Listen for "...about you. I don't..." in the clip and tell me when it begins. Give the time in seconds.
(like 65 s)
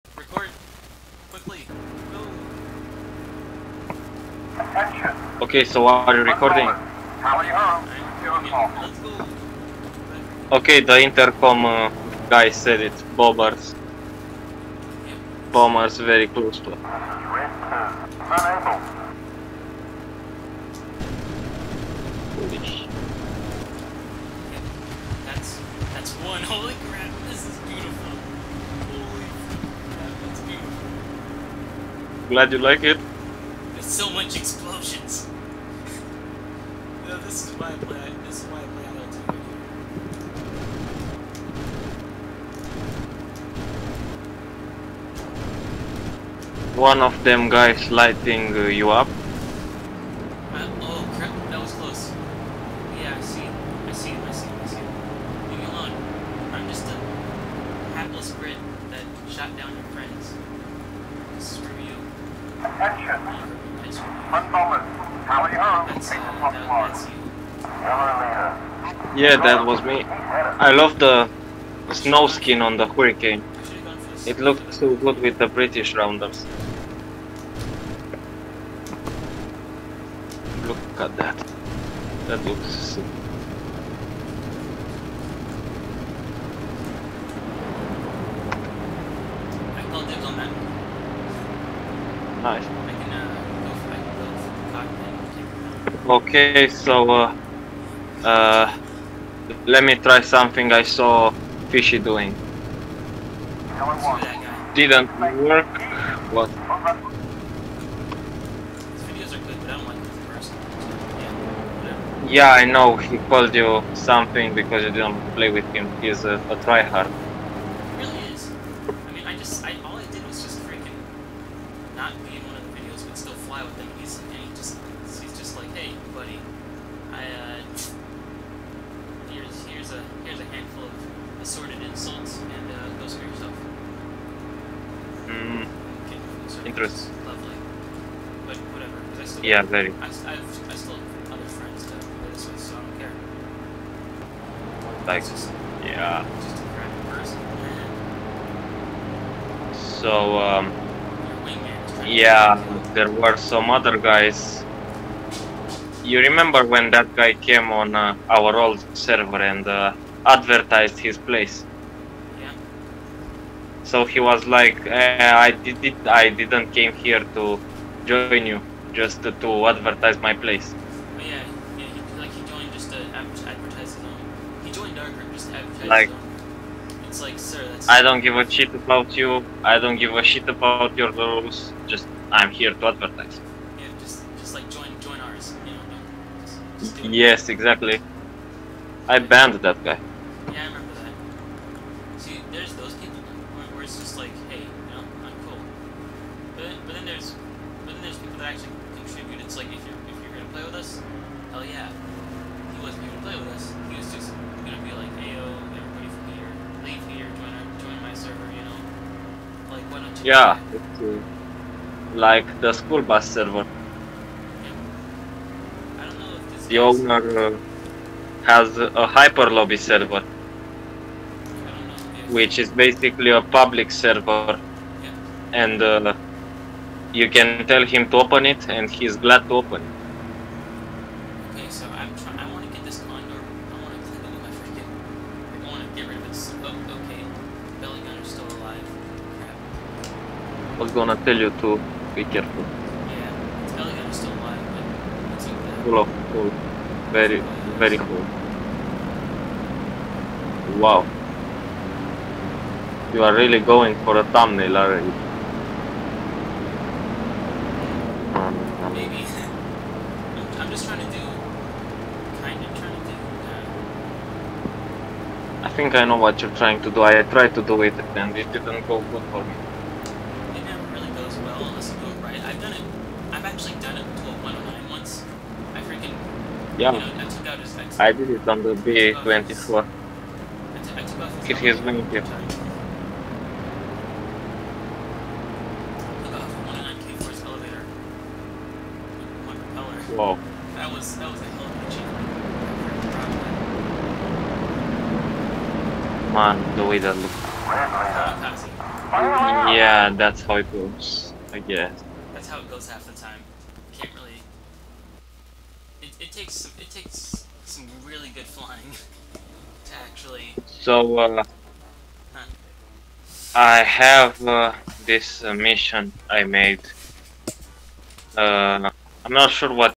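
178 s.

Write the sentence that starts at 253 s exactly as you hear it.
You are really going for a thumbnail, are you?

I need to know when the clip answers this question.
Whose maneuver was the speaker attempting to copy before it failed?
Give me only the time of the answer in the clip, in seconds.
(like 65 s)
101 s.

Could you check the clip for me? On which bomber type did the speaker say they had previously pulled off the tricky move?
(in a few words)
B-24.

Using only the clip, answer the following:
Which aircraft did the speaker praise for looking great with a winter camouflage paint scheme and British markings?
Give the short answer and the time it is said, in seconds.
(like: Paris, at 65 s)
Hurricane, at 72 s.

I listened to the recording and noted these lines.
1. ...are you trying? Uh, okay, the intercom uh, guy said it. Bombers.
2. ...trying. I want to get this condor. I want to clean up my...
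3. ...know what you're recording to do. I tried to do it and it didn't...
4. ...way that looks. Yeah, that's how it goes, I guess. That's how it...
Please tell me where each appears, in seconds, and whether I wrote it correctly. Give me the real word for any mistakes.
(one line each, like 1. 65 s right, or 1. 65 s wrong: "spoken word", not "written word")
1. 5 s wrong: "recording", not "trying"
2. 232 s right
3. 266 s wrong: "trying", not "recording"
4. 296 s right.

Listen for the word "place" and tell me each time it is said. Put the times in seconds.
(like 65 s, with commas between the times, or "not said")
161 s, 170 s.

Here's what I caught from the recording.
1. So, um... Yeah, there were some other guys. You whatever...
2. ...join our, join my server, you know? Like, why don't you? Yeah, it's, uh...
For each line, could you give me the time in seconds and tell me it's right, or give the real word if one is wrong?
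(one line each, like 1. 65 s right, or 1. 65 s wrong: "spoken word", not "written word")
1. 150 s wrong: "remember", not "whatever"
2. 207 s right.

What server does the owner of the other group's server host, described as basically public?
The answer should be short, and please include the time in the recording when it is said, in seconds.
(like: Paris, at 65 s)
HyperLobby, at 219 s.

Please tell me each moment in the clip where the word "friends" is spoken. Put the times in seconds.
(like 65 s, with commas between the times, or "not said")
59 s, 141 s.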